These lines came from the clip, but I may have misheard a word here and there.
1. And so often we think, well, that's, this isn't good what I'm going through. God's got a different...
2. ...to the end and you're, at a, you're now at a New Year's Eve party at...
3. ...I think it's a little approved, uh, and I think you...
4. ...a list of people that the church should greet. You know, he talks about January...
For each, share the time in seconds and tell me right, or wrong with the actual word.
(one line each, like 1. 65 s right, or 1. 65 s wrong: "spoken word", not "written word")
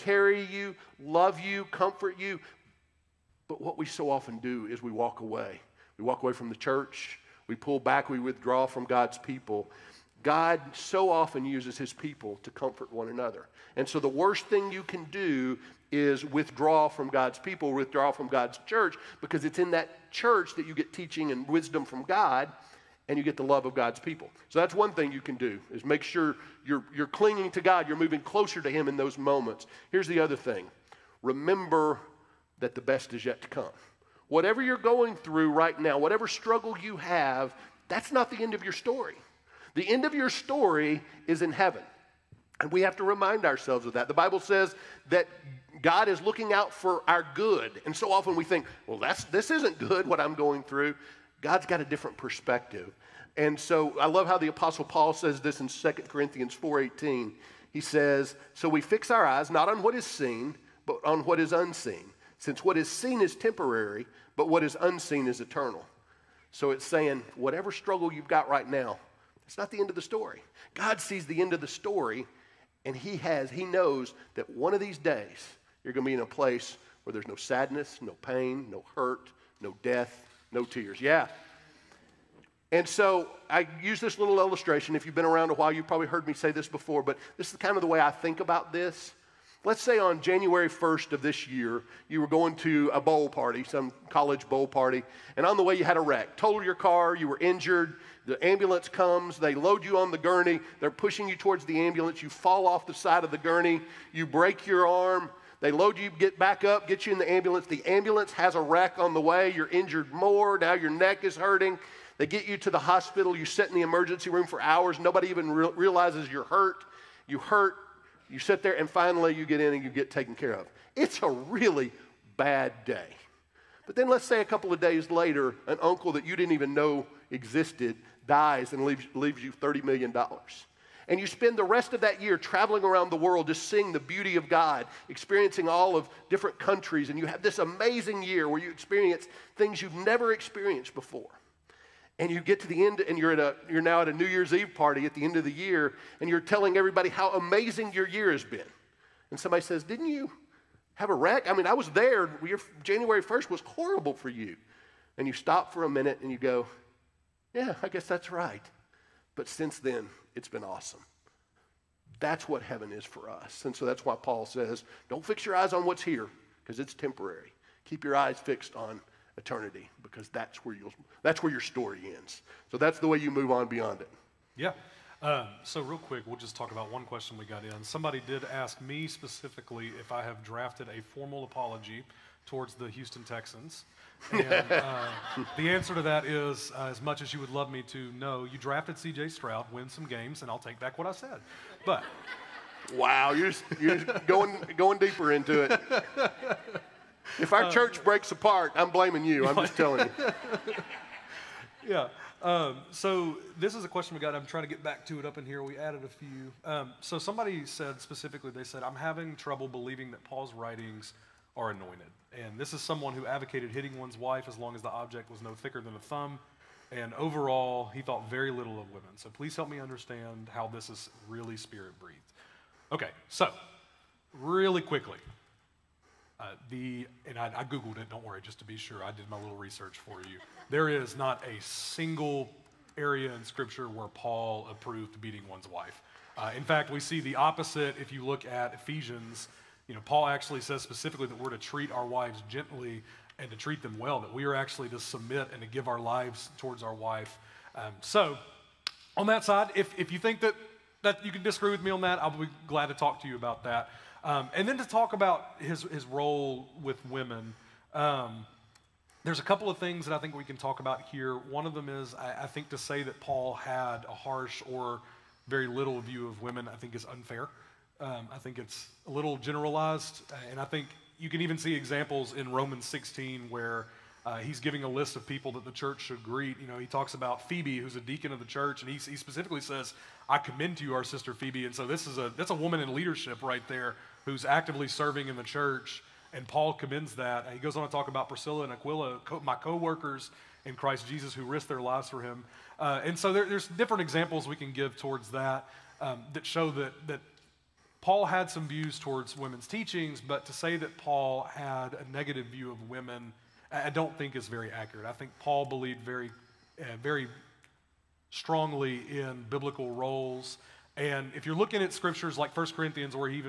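1. 47 s right
2. 142 s right
3. 268 s wrong: "generalized", not "approved"
4. 274 s wrong: "Phoebe", not "January".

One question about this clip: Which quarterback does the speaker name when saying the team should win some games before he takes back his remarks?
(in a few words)
C.J. Stroud.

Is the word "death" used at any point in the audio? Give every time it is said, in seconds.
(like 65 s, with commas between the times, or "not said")
79 s.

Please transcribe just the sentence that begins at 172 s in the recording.
So that's the way you move on beyond it.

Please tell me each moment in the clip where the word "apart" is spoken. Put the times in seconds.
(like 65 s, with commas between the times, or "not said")
198 s.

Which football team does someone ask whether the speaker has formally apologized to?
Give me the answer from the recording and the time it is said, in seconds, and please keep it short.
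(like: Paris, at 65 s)
Houston Texans, at 182 s.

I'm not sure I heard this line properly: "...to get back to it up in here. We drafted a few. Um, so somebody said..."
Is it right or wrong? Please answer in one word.
wrong.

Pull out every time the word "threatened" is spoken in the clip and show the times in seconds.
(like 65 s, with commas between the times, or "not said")
not said.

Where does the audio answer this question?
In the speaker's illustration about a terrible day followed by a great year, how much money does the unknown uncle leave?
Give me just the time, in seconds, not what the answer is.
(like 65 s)
129 s.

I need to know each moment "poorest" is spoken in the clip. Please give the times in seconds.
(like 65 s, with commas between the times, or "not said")
not said.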